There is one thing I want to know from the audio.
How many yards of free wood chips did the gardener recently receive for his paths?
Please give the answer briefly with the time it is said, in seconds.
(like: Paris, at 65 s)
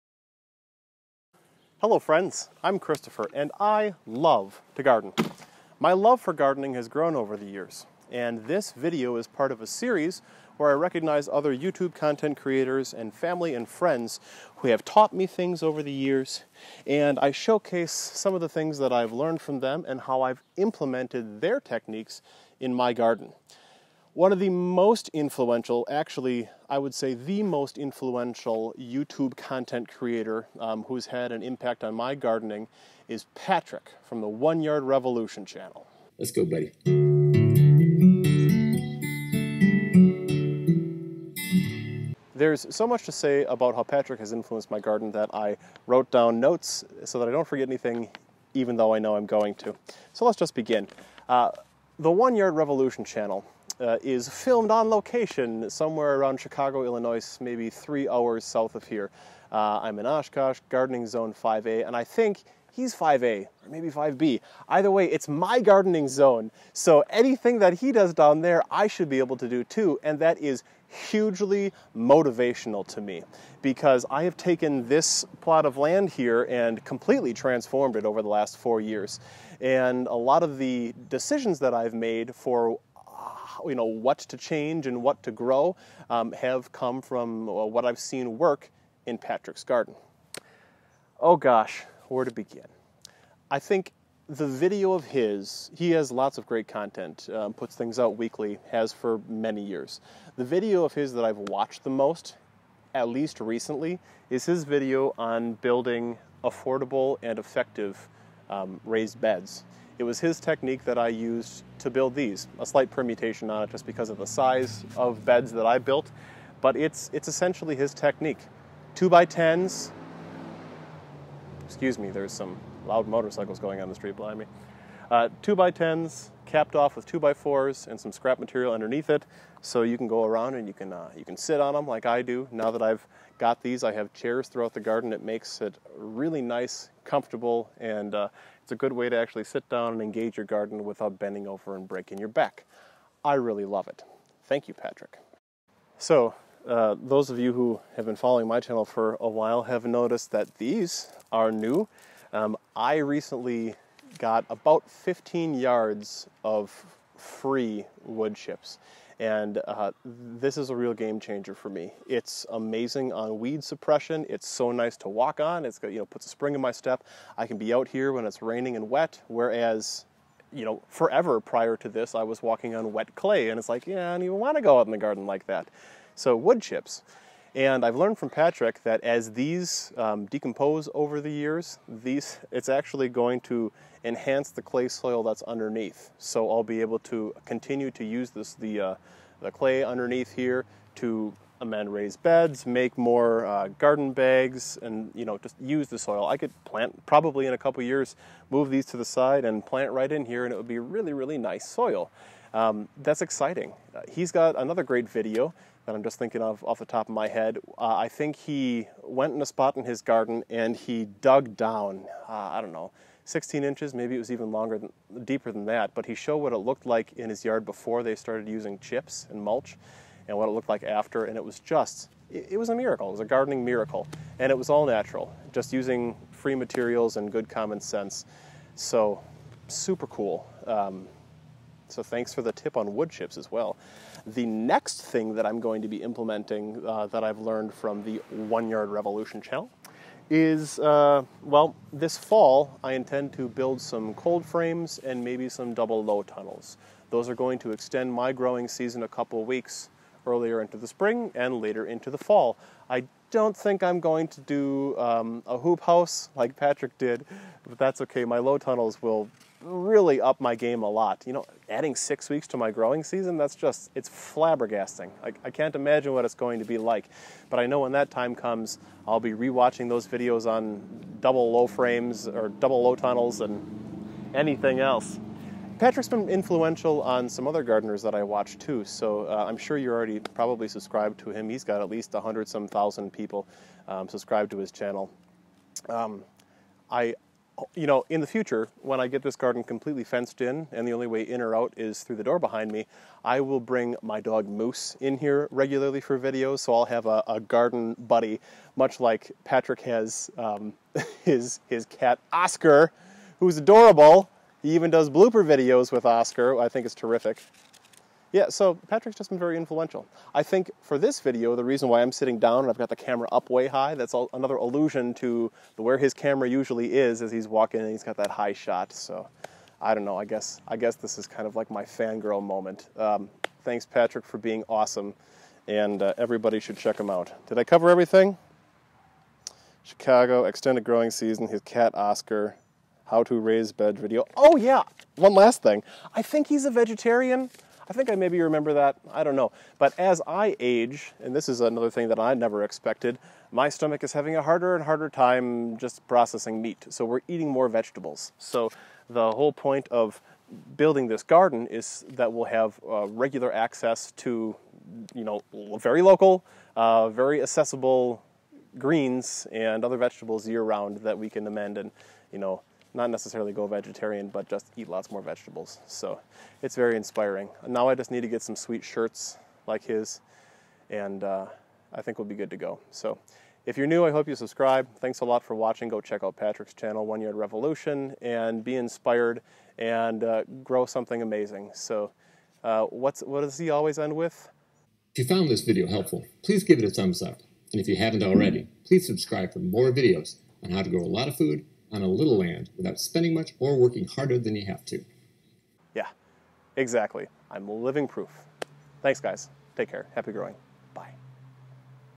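15, at 154 s.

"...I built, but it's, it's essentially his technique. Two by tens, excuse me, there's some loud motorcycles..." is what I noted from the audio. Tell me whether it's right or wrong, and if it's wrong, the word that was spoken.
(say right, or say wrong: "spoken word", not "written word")
right.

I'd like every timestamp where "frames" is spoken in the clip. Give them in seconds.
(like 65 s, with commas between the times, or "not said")
244 s, 271 s.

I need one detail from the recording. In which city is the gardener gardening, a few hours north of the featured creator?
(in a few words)
Oshkosh.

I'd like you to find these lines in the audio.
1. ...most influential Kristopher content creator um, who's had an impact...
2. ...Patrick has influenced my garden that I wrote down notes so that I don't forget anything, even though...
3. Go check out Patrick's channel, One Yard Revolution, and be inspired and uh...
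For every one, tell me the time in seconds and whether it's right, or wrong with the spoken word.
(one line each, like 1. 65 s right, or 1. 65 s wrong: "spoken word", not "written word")
1. 27 s wrong: "YouTube", not "Kristopher"
2. 43 s right
3. 375 s right.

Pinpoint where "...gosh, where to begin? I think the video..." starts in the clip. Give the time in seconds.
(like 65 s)
91 s.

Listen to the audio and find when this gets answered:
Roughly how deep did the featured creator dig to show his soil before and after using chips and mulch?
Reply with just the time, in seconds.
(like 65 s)
213 s.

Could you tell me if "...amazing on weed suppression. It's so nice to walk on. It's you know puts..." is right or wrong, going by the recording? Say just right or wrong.
right.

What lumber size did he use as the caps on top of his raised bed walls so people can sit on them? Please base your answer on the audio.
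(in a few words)
2 by 4s.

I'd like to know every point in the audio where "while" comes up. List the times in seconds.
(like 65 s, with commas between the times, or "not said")
149 s.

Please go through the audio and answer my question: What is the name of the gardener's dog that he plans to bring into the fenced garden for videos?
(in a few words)
Moose.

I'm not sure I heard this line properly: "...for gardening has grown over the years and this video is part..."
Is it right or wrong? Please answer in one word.
right.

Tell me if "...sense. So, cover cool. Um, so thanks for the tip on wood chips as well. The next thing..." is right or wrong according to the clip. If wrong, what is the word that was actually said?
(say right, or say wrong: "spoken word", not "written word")
wrong: "super", not "cover".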